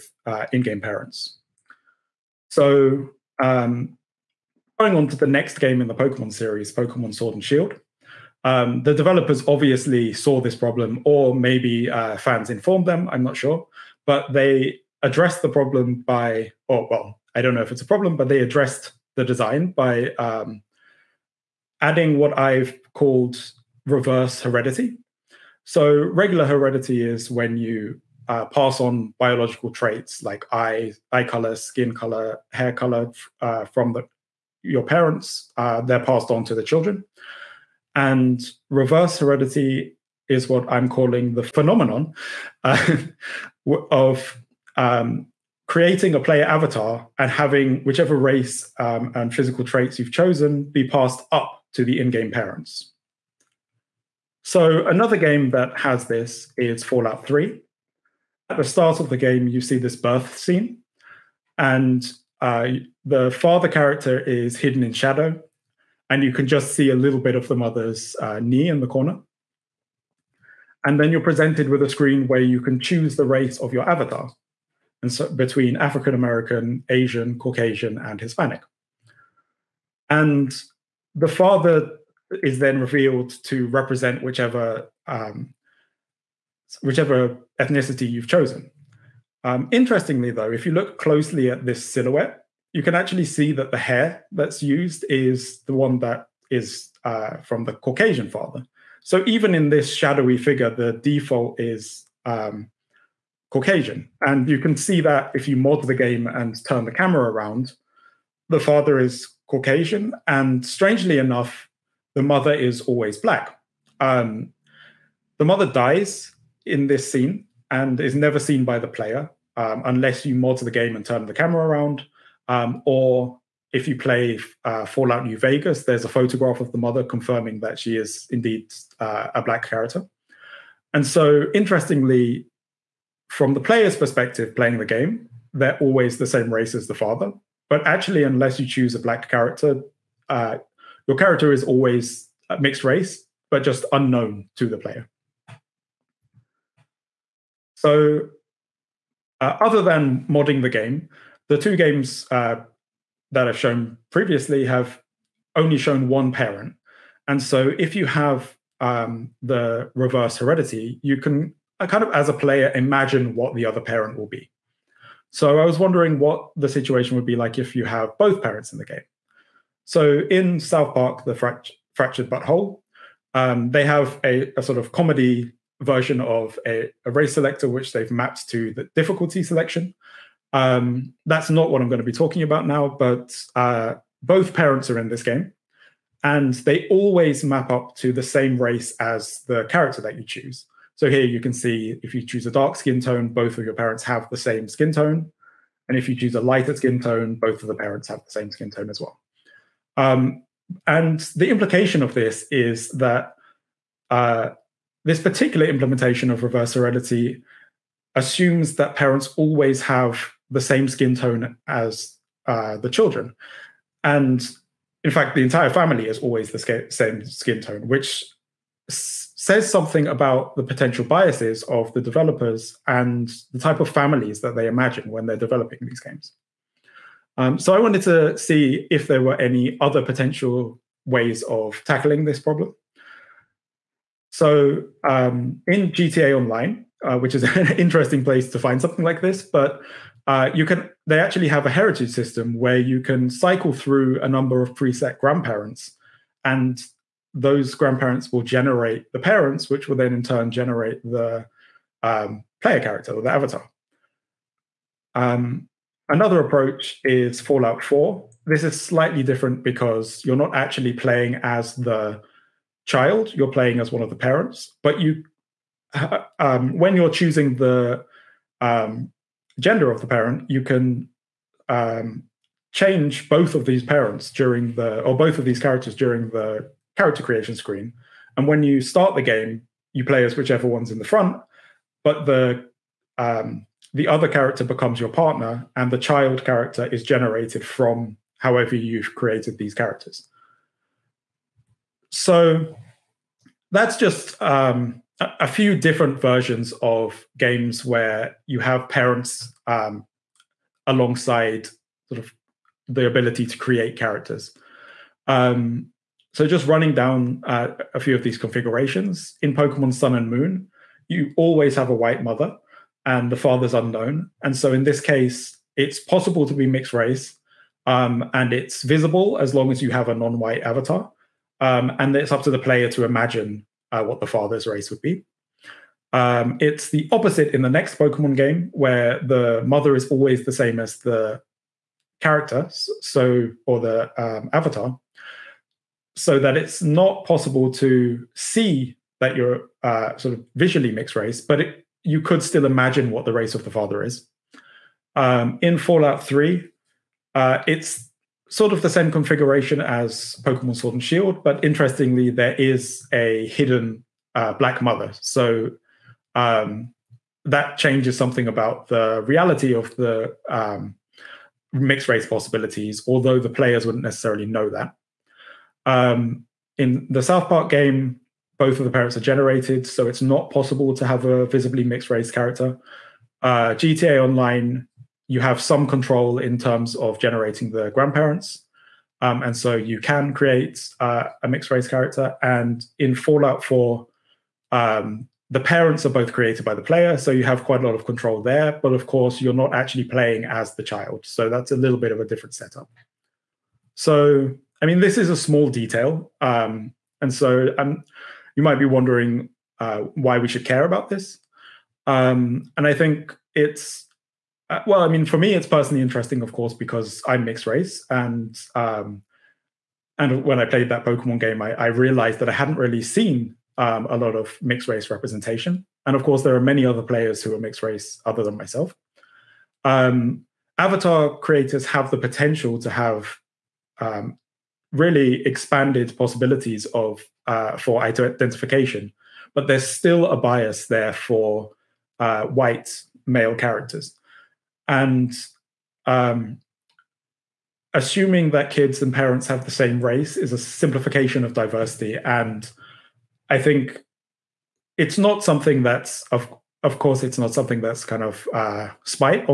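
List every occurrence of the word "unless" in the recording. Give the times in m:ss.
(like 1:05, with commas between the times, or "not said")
1:59, 2:18.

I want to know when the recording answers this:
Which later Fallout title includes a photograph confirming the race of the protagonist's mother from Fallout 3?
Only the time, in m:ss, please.
2:04.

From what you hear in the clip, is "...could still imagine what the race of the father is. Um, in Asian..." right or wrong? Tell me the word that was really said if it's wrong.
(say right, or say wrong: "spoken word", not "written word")
wrong: "Fallout", not "Asian".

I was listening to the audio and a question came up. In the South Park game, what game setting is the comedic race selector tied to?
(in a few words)
Difficulty selection.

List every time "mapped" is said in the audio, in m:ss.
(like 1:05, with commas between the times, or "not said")
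2:58.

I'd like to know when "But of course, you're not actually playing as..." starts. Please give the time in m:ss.
6:28.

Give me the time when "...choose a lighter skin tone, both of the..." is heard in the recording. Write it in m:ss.
3:16.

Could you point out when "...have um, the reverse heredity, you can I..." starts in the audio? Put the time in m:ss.
2:38.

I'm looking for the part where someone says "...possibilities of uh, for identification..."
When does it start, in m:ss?
7:06.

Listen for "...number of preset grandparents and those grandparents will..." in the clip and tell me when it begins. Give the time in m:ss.
4:04.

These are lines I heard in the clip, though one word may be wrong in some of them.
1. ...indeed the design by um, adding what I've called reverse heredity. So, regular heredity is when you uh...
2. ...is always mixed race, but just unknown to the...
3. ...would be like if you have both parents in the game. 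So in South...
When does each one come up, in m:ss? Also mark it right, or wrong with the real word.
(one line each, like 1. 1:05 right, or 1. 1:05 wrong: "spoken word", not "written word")
1. 0:18 wrong: "addressed", not "indeed"
2. 2:21 right
3. 2:47 right.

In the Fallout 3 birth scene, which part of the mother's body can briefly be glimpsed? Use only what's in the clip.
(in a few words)
Knee.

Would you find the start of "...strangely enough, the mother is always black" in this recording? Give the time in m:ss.
1:50.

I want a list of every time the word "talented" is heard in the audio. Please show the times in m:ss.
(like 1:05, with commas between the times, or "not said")
not said.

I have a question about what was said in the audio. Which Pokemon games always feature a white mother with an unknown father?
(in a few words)
Pokemon Sun and Moon.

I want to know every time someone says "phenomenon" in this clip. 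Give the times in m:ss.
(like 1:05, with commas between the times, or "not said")
0:41.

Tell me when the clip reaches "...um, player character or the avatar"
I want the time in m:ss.
4:12.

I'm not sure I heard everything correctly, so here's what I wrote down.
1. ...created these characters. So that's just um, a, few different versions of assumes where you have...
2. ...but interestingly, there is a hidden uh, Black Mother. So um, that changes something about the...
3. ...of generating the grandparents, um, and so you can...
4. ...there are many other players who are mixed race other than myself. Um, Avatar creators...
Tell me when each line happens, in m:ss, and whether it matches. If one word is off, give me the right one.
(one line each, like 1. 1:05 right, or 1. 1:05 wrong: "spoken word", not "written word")
1. 4:49 wrong: "games", not "assumes"
2. 5:51 right
3. 6:16 right
4. 6:56 right.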